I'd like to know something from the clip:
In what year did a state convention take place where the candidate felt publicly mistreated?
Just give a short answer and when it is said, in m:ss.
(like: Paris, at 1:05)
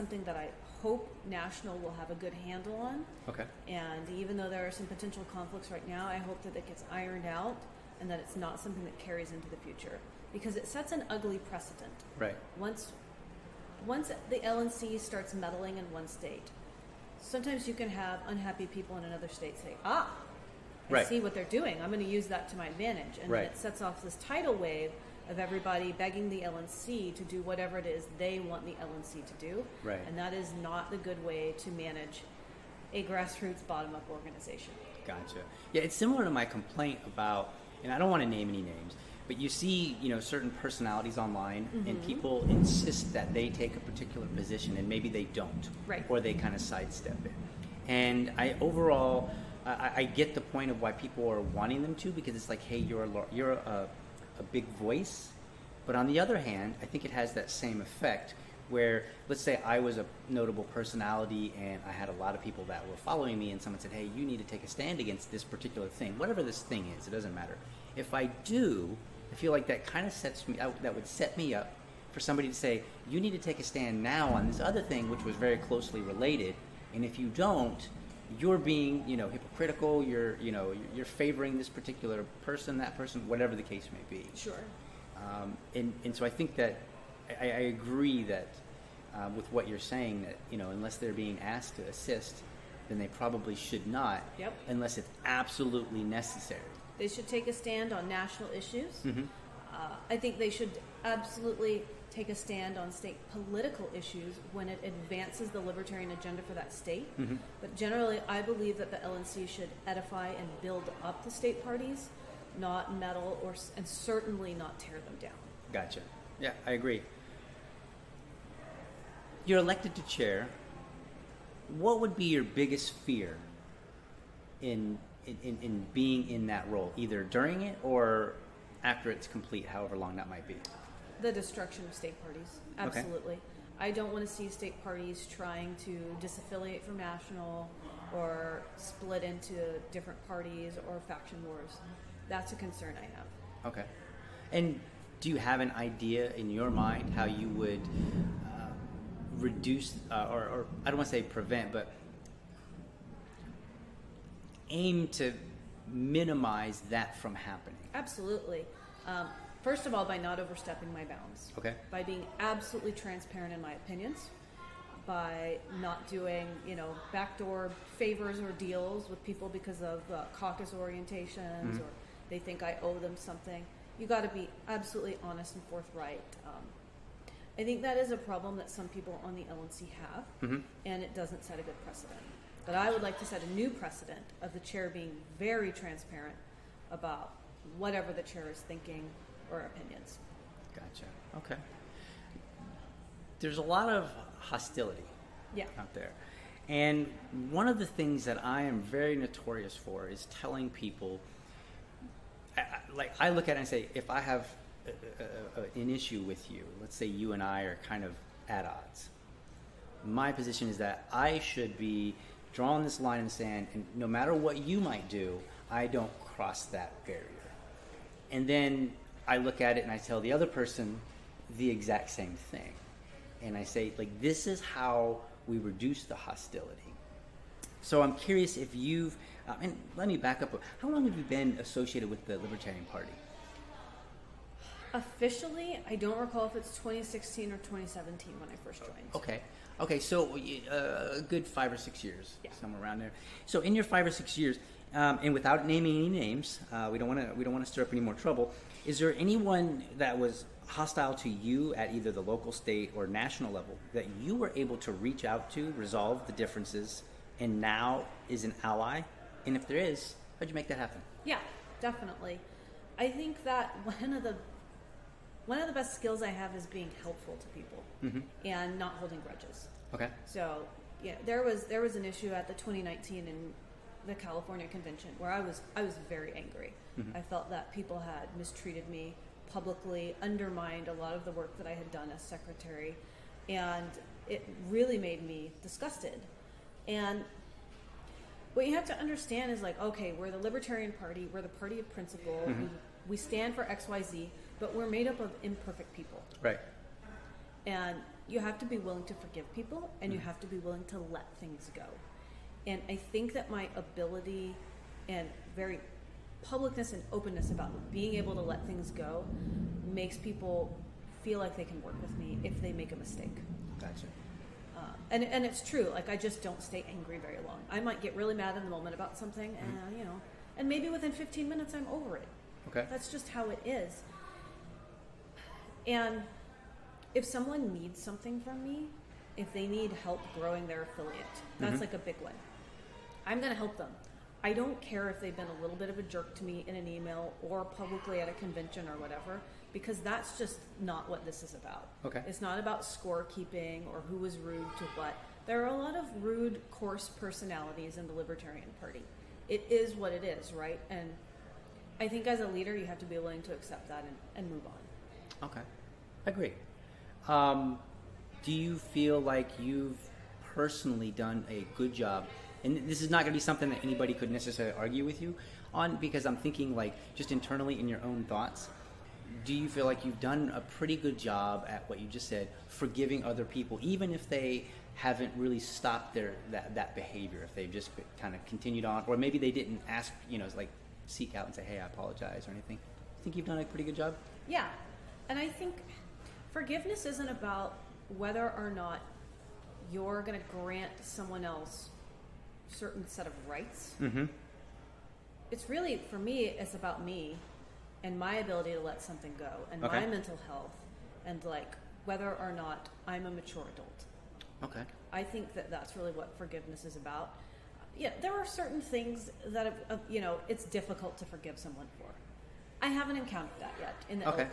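2019, at 4:32.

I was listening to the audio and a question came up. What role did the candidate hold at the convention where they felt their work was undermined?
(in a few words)
secretary.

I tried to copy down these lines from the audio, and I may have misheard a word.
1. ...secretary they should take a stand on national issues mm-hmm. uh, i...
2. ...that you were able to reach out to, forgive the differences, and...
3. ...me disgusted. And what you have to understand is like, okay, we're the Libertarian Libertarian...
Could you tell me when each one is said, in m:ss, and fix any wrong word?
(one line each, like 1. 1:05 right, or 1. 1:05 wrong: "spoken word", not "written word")
1. 1:36 wrong: "necessary", not "secretary"
2. 4:13 wrong: "resolve", not "forgive"
3. 4:45 wrong: "Party", not "Libertarian".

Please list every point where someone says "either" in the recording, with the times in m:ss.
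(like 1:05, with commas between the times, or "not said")
2:06, 4:11.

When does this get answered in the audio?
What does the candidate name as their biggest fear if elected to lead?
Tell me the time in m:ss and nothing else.
2:11.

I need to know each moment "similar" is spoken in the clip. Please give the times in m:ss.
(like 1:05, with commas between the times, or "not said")
0:35.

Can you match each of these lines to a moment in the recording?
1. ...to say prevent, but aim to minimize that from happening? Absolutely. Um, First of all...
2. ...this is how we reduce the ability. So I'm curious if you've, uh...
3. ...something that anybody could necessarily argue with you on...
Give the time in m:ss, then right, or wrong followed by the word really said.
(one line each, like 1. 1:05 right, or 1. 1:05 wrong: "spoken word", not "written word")
1. 2:31 right
2. 3:44 wrong: "hostility", not "ability"
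3. 6:03 right.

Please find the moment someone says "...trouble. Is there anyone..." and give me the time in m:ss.
4:08.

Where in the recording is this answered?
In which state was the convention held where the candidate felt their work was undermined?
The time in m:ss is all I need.
4:34.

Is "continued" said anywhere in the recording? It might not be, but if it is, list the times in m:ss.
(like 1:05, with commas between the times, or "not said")
6:18.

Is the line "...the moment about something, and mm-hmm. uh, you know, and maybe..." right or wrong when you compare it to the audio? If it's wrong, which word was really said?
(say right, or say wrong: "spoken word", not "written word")
right.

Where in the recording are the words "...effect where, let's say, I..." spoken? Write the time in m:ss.
0:57.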